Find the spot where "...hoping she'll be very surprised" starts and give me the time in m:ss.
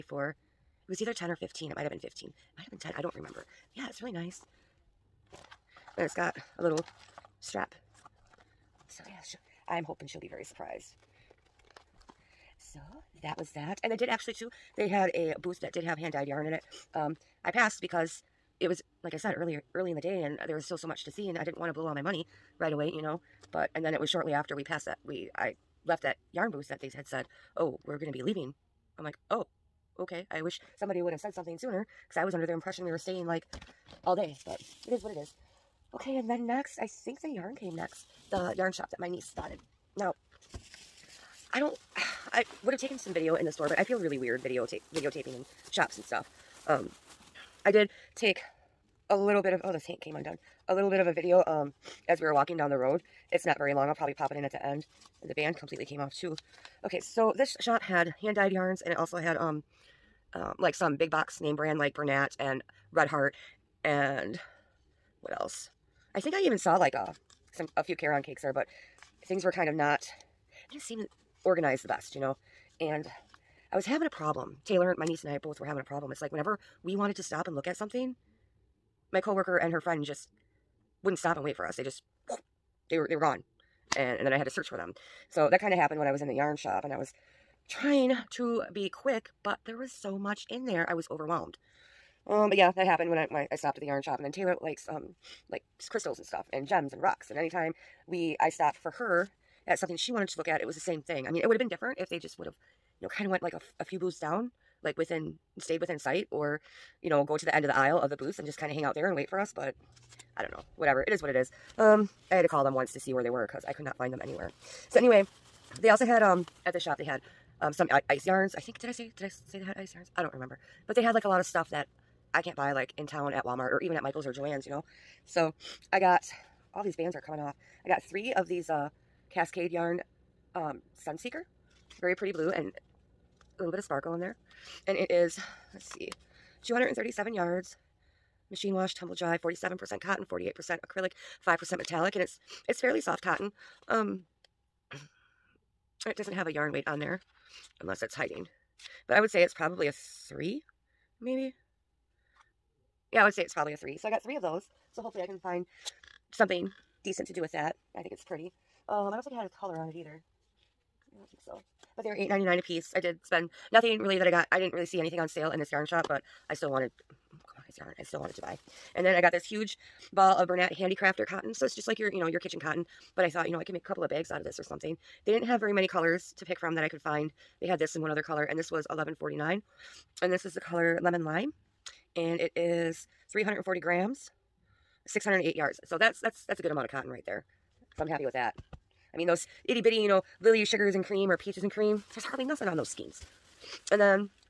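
0:09.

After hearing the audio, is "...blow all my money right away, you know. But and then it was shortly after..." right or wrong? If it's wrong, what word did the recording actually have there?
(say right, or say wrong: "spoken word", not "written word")
right.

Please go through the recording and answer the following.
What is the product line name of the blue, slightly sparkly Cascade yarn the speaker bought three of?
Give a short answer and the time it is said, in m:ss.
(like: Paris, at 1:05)
Sunseeker, at 2:11.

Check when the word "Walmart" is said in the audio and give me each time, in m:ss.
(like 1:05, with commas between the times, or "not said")
2:03.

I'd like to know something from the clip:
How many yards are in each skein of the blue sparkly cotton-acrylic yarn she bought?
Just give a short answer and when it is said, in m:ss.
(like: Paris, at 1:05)
237, at 2:16.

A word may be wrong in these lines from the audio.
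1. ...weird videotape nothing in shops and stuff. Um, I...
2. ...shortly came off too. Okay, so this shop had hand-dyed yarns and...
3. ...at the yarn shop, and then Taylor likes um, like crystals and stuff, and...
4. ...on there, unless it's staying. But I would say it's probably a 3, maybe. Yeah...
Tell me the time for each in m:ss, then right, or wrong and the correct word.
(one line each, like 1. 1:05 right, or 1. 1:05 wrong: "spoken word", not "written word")
1. 0:44 wrong: "videotaping", not "nothing"
2. 0:55 wrong: "completely", not "shortly"
3. 1:33 right
4. 2:26 wrong: "hiding", not "staying".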